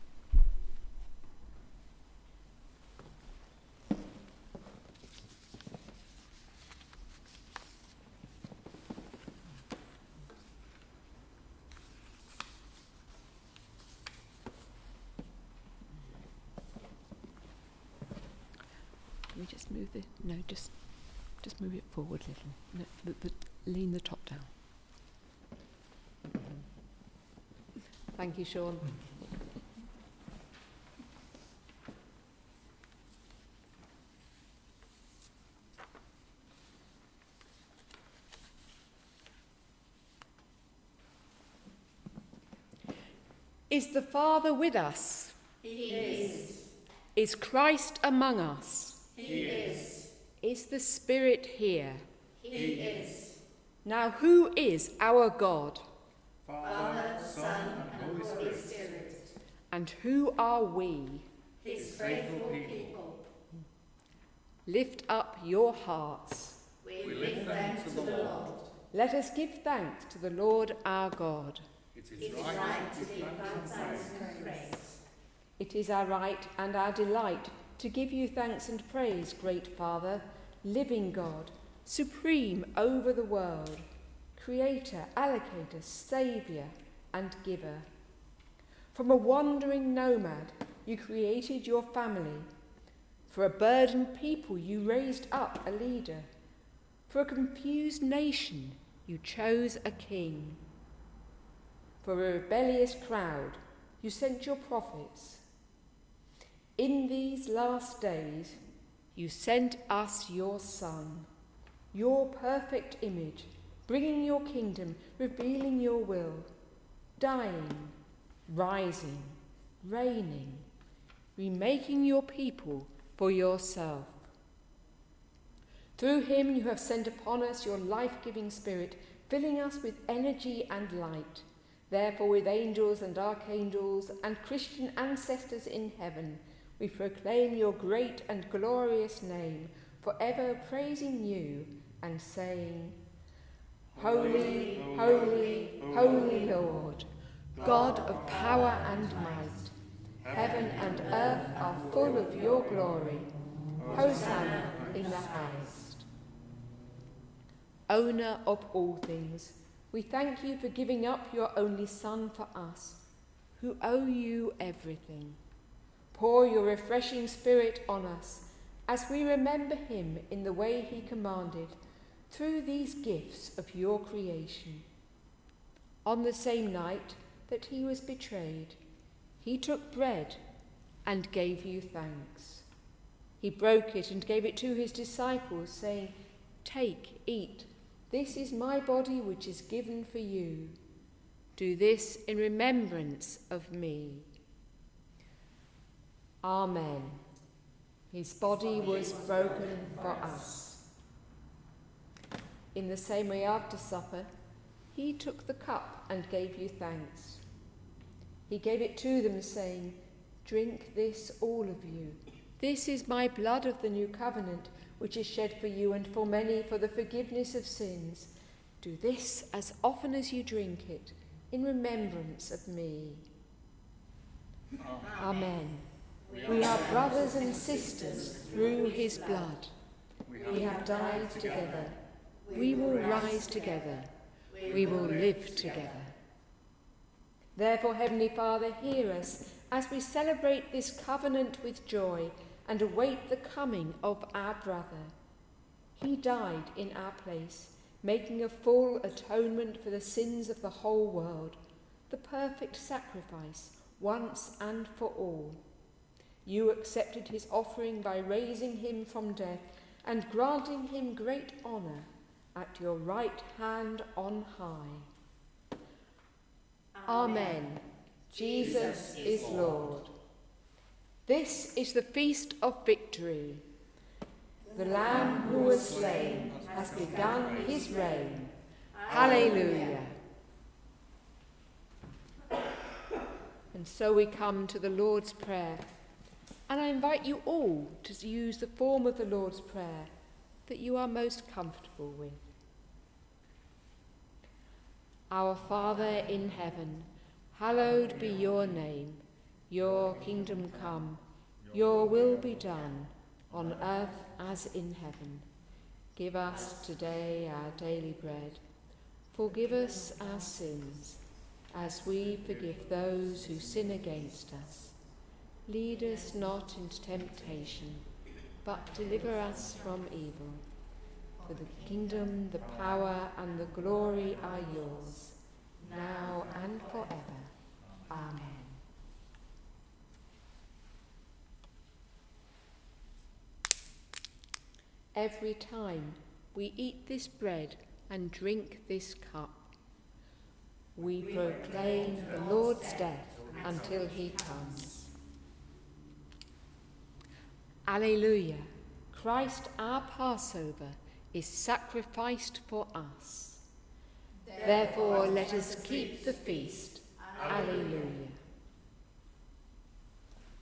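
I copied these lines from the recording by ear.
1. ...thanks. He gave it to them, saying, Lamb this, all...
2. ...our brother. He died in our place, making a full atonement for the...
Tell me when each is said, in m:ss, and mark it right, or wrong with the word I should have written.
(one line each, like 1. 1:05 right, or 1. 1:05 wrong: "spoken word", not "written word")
1. 3:26 wrong: "Drink", not "Lamb"
2. 4:04 right.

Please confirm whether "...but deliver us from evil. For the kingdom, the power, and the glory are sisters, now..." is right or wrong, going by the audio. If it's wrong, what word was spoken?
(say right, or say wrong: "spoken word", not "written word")
wrong: "yours", not "sisters".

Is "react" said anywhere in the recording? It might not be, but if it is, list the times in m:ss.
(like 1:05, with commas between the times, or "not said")
not said.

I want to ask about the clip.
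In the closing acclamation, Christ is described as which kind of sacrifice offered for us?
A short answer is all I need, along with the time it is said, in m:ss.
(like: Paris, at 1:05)
Passover, at 5:50.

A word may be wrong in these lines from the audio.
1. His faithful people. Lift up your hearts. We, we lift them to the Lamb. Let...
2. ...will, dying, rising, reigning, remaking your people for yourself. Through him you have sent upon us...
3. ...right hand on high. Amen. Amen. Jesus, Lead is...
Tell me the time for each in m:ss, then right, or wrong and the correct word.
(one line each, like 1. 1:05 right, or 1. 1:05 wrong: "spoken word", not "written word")
1. 1:01 wrong: "Lord", not "Lamb"
2. 1:55 right
3. 4:22 wrong: "Jesus", not "Lead".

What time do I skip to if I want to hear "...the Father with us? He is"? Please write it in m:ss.
0:43.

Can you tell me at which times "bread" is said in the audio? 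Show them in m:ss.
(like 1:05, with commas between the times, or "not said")
2:59, 5:08, 5:37.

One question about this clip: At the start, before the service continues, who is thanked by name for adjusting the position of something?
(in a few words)
Sean.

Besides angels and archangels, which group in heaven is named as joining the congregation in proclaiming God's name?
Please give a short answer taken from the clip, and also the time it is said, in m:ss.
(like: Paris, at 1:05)
Christian ancestors, at 2:14.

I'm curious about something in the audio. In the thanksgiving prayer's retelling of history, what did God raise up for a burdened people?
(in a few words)
a leader.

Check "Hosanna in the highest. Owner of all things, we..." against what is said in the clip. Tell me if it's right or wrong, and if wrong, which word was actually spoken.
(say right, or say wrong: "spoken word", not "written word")
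right.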